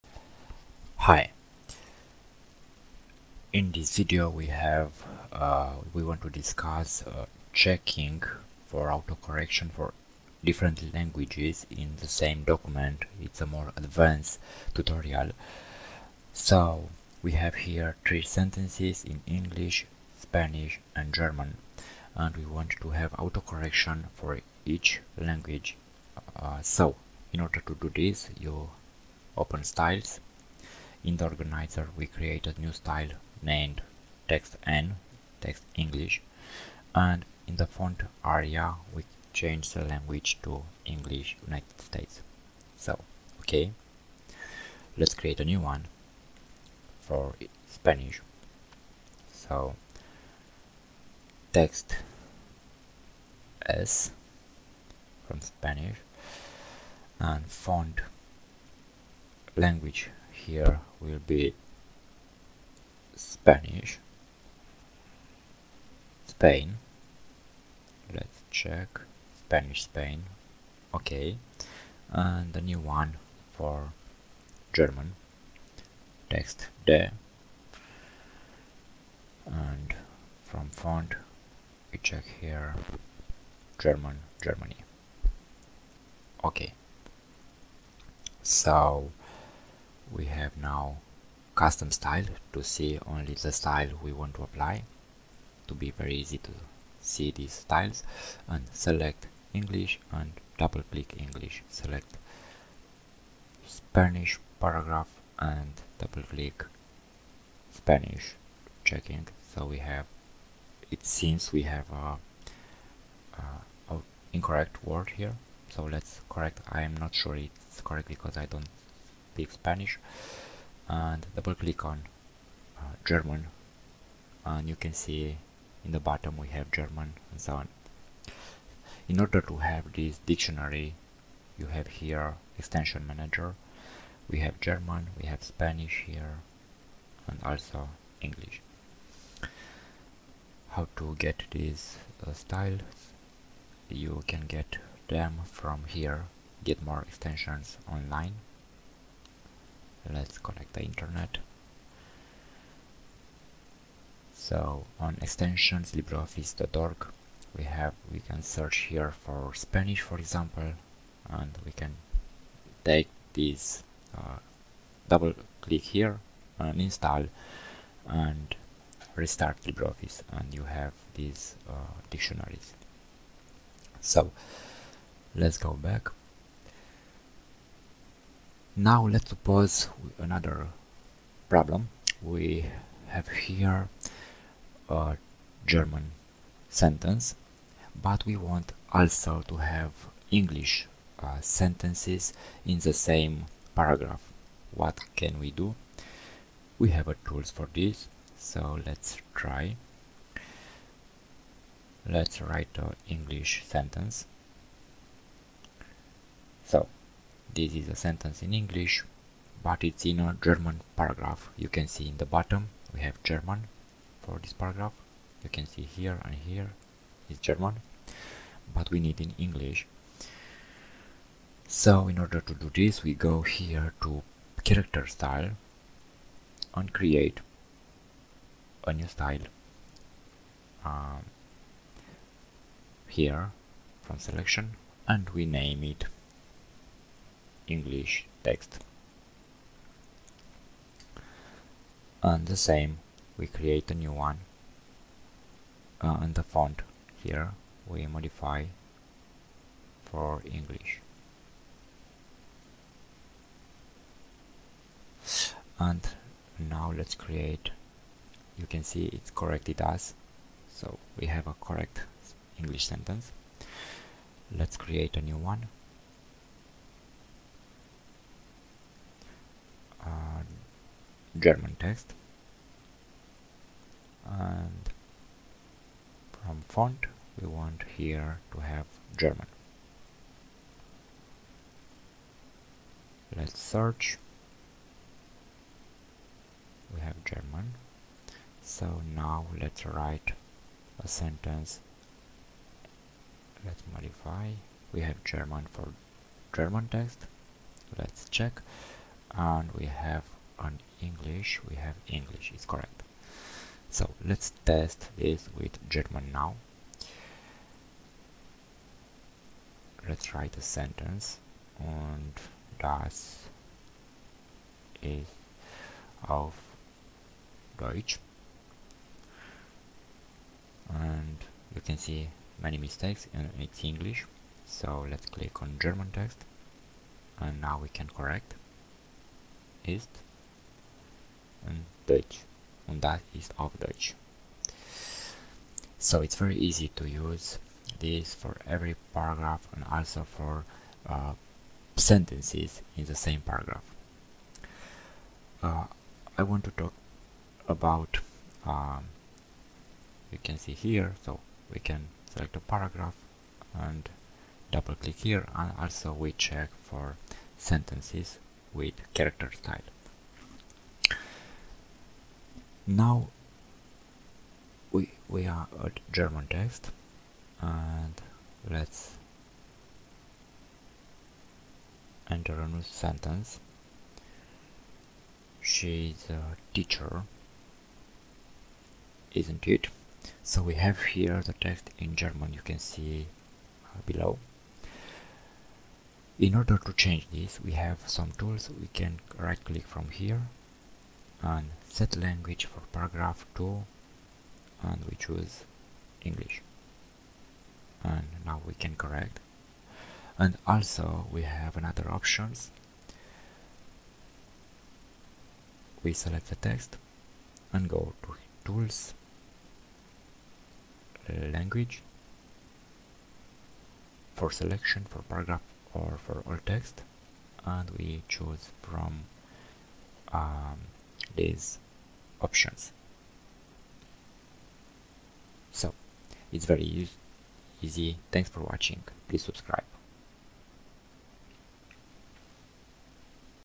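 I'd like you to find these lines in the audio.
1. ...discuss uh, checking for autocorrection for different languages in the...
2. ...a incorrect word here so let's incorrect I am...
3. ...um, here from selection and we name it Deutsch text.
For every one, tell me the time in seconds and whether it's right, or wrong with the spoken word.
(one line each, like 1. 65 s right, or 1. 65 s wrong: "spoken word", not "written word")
1. 6 s right
2. 113 s wrong: "correct", not "incorrect"
3. 230 s wrong: "English", not "Deutsch".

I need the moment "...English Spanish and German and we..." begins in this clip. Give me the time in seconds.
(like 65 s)
19 s.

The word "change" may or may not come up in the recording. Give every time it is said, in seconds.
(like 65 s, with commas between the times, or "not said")
39 s, 386 s.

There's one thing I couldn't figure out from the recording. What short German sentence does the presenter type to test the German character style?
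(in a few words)
das ist auf Deutsch.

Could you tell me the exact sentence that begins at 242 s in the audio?
And the same, we create a new one.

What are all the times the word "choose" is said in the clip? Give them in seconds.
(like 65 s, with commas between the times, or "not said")
395 s, 418 s.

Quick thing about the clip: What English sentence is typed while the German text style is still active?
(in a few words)
She's a teacher, isn't it.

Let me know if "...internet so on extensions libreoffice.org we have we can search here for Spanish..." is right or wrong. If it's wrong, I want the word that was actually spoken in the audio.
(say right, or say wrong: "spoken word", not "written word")
right.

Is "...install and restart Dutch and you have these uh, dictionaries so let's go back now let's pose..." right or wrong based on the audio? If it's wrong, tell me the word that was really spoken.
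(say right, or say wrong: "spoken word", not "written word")
wrong: "LibreOffice", not "Dutch".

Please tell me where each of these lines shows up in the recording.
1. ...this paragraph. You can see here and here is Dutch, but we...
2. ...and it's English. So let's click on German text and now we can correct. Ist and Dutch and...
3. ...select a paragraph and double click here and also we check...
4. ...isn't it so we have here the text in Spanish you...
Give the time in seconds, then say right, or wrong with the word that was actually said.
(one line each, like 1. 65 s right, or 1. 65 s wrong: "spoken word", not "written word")
1. 214 s wrong: "German", not "Dutch"
2. 323 s right
3. 352 s right
4. 379 s wrong: "German", not "Spanish".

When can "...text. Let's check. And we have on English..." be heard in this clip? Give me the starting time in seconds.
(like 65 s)
296 s.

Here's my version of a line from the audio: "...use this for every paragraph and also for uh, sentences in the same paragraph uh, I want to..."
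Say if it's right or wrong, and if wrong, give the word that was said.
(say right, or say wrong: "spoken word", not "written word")
right.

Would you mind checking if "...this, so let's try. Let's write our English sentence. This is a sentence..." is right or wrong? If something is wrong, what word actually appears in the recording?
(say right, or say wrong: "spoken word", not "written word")
right.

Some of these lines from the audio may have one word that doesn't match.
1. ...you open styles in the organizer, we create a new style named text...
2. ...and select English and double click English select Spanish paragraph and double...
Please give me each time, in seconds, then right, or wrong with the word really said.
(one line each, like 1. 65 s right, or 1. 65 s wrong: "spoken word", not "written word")
1. 28 s right
2. 98 s right.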